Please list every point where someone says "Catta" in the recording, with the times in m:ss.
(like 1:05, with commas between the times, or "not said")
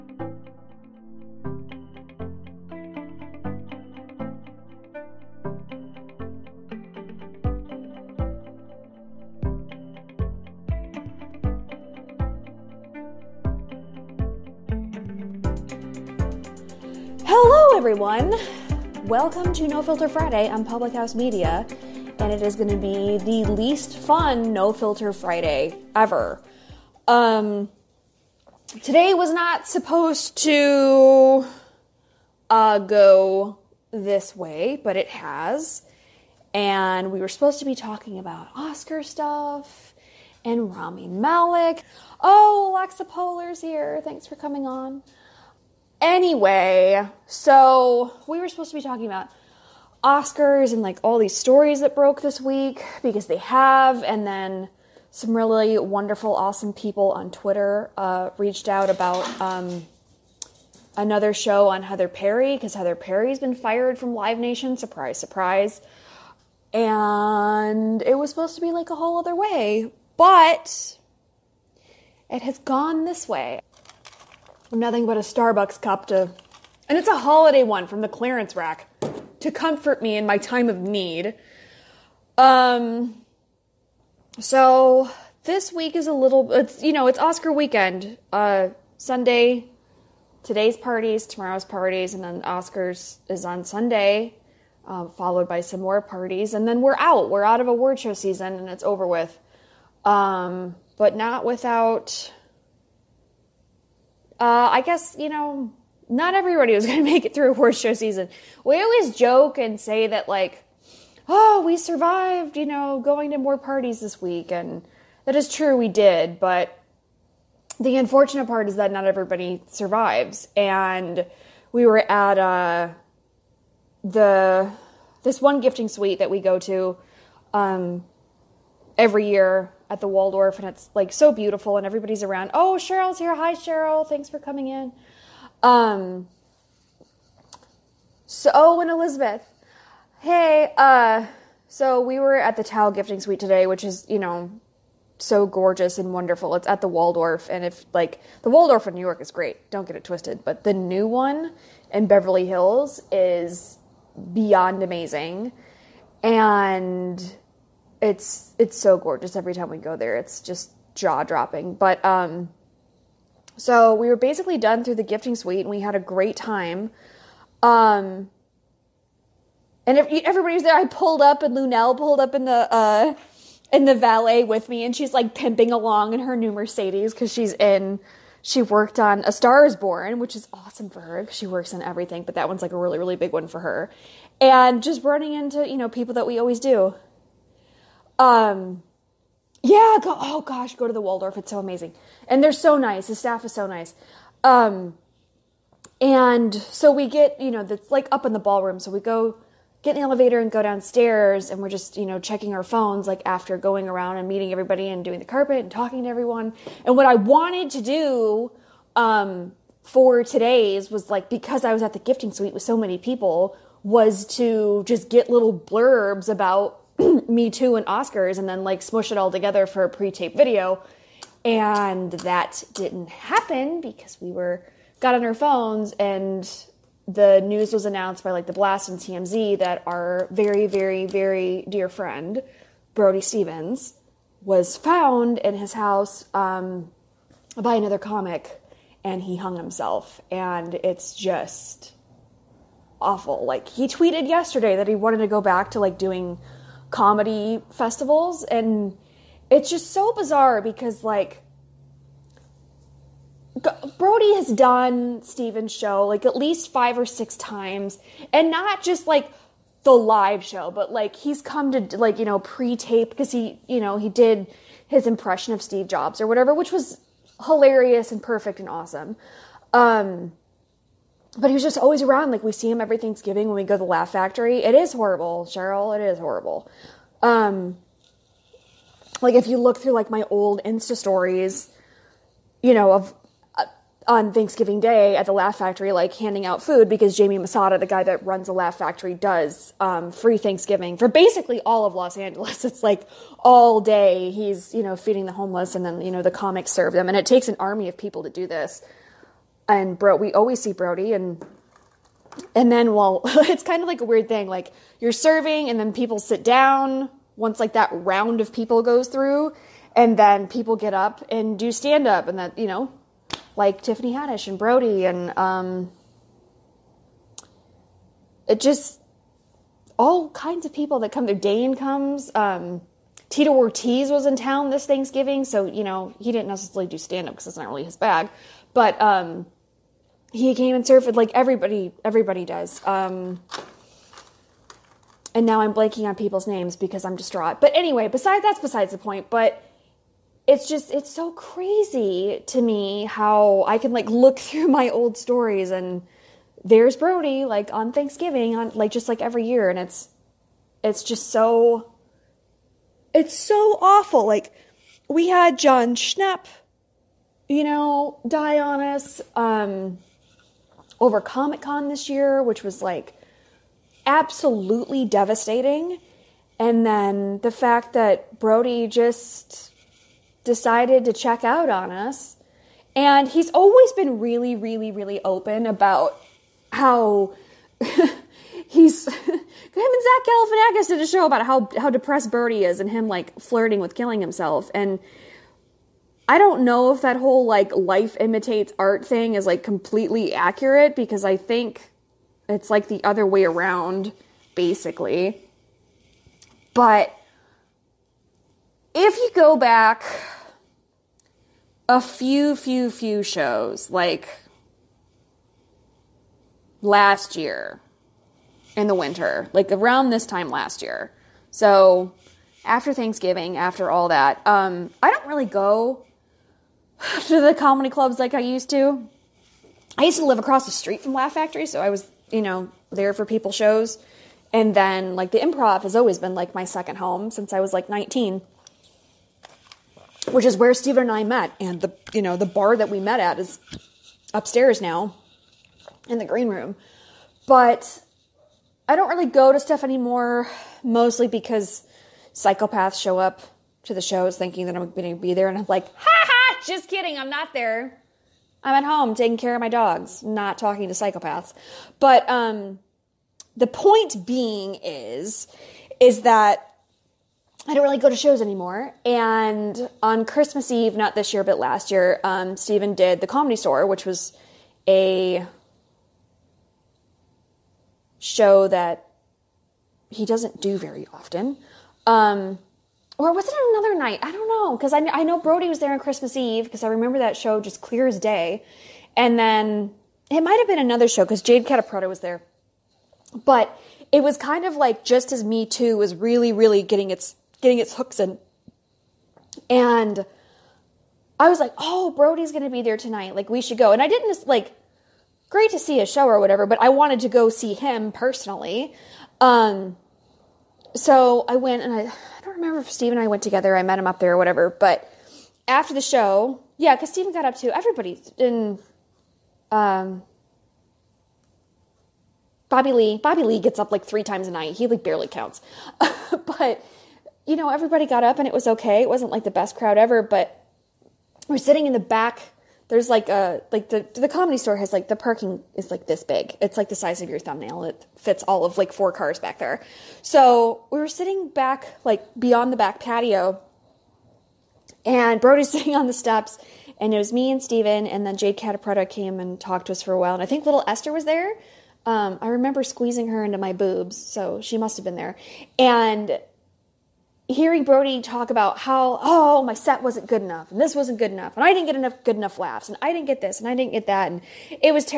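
8:01, 8:58.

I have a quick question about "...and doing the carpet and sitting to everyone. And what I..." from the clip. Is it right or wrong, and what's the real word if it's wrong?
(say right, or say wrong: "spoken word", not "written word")
wrong: "talking", not "sitting".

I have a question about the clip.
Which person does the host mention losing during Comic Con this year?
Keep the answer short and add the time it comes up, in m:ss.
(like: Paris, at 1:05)
Jon Schnepp, at 5:55.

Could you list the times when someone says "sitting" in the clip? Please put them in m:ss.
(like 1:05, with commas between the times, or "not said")
8:41, 8:51, 8:55.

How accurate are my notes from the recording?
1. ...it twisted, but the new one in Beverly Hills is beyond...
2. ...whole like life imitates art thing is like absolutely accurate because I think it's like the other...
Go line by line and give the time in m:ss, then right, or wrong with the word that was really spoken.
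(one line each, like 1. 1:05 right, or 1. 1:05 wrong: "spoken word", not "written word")
1. 2:29 right
2. 6:27 wrong: "completely", not "absolutely".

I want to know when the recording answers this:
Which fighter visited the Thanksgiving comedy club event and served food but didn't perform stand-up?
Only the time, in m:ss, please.
5:23.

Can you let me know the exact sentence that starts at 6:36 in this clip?
But if you go back a few, few, few shows, like last year in the winter, like around this time last year.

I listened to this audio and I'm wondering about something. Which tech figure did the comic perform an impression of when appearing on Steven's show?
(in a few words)
Steve Jobs.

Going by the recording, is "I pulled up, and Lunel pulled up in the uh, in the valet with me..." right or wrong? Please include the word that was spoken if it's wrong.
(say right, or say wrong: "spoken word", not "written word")
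right.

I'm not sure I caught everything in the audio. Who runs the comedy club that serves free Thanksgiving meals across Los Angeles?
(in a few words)
Jamie Masada.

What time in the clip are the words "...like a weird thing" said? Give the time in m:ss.
5:03.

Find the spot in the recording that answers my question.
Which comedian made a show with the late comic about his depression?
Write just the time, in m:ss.
6:20.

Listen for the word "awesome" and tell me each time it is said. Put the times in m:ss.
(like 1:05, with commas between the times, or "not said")
0:56, 3:00, 4:28.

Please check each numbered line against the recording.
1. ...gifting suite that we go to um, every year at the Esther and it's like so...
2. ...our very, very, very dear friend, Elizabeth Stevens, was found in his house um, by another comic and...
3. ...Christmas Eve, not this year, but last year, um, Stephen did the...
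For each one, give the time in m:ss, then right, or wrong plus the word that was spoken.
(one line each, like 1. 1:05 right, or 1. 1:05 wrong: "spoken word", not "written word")
1. 2:05 wrong: "Waldorf", not "Esther"
2. 3:49 wrong: "Brody", not "Elizabeth"
3. 7:40 right.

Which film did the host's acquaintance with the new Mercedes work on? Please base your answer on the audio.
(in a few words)
A Star Is Born.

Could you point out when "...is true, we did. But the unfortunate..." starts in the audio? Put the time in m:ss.
1:55.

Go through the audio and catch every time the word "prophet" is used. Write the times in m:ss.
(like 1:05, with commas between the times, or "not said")
not said.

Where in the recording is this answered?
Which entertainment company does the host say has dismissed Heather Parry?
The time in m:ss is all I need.
1:04.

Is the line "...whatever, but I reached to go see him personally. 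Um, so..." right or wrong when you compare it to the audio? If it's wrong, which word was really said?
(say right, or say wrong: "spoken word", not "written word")
wrong: "wanted", not "reached".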